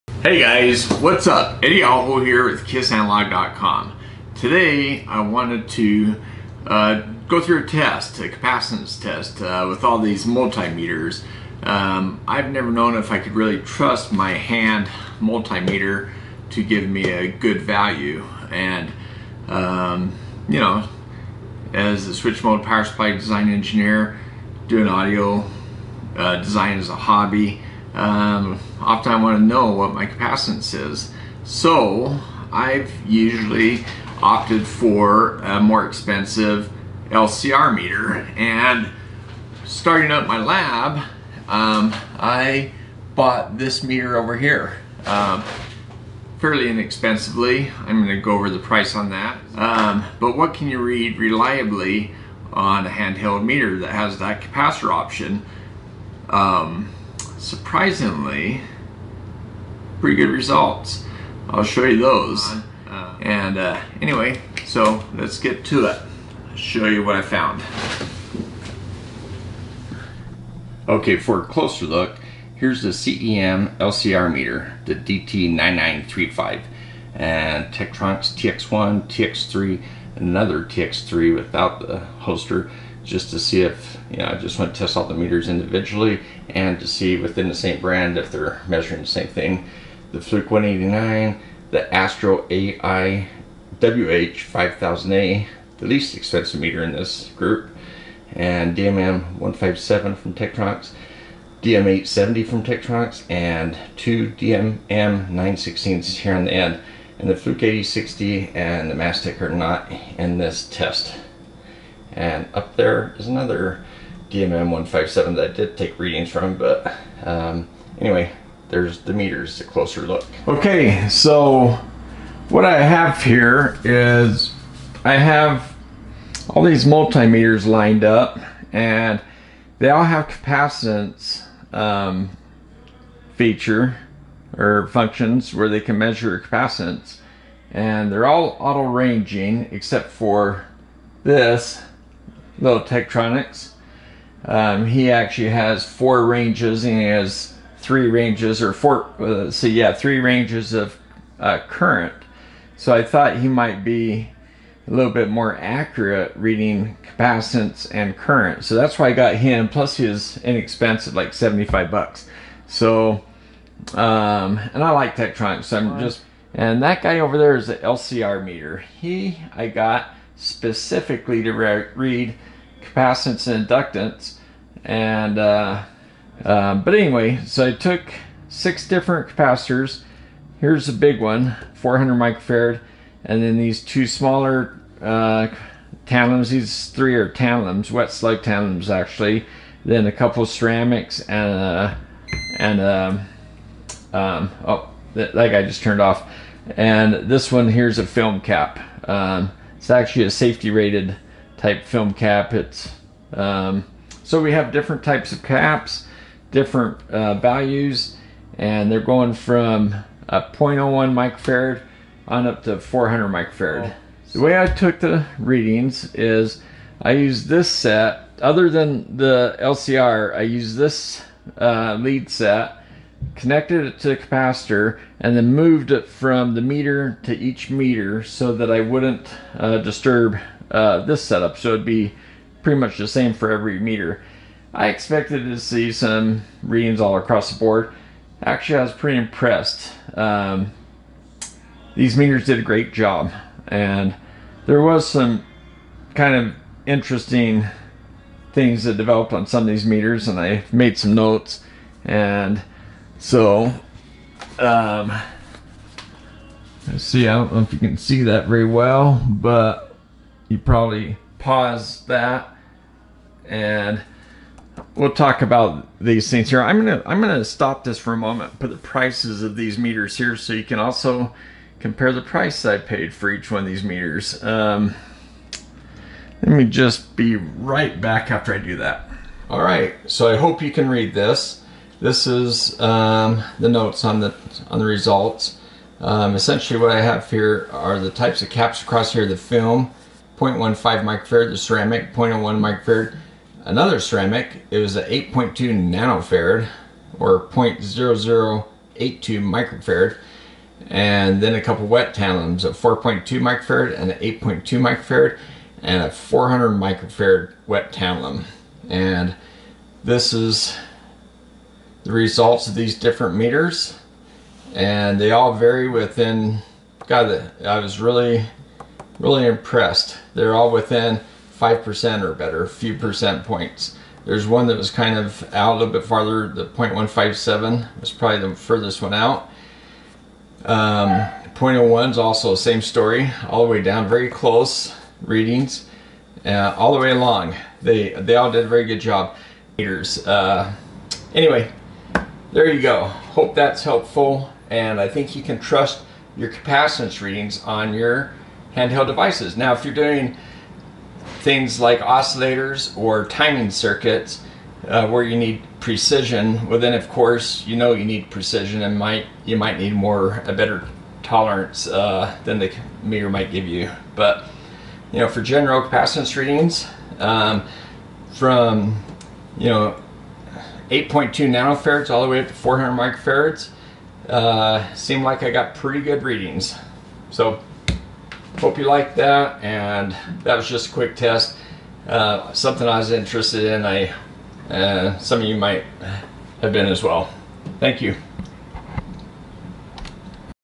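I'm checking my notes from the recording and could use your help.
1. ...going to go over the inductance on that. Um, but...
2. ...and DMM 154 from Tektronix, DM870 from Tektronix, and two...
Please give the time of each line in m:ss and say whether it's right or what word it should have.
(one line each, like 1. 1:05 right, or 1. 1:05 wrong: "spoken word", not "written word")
1. 0:48 wrong: "price", not "inductance"
2. 1:38 wrong: "157", not "154".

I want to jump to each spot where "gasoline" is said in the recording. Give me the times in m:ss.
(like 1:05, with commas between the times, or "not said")
not said.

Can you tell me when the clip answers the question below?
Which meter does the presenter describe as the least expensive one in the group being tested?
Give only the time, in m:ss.
1:31.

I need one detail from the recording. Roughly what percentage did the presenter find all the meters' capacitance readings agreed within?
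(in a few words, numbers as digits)
5%.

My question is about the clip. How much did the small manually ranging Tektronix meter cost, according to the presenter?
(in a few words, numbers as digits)
75 dollars.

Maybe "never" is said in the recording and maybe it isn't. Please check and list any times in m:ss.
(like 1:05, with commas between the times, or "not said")
0:12.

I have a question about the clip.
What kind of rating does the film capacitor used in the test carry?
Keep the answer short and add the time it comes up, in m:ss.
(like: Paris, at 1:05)
safety rated, at 3:20.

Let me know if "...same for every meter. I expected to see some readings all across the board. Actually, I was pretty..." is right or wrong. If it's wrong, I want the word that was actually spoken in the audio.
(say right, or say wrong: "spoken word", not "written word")
right.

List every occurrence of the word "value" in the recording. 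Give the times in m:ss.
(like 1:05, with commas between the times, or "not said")
0:17, 3:27.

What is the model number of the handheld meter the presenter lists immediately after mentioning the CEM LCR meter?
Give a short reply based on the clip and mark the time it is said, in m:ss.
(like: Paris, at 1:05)
DT9935, at 1:14.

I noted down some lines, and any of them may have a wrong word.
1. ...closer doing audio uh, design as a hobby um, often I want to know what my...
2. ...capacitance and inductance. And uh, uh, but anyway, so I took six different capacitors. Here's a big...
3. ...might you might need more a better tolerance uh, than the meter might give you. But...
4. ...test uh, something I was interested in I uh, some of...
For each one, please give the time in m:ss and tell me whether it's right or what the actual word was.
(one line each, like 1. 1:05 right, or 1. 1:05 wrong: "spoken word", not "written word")
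1. 0:23 wrong: "engineer", not "closer"
2. 2:52 right
3. 5:58 right
4. 6:21 right.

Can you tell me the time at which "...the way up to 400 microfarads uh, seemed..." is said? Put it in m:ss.
6:12.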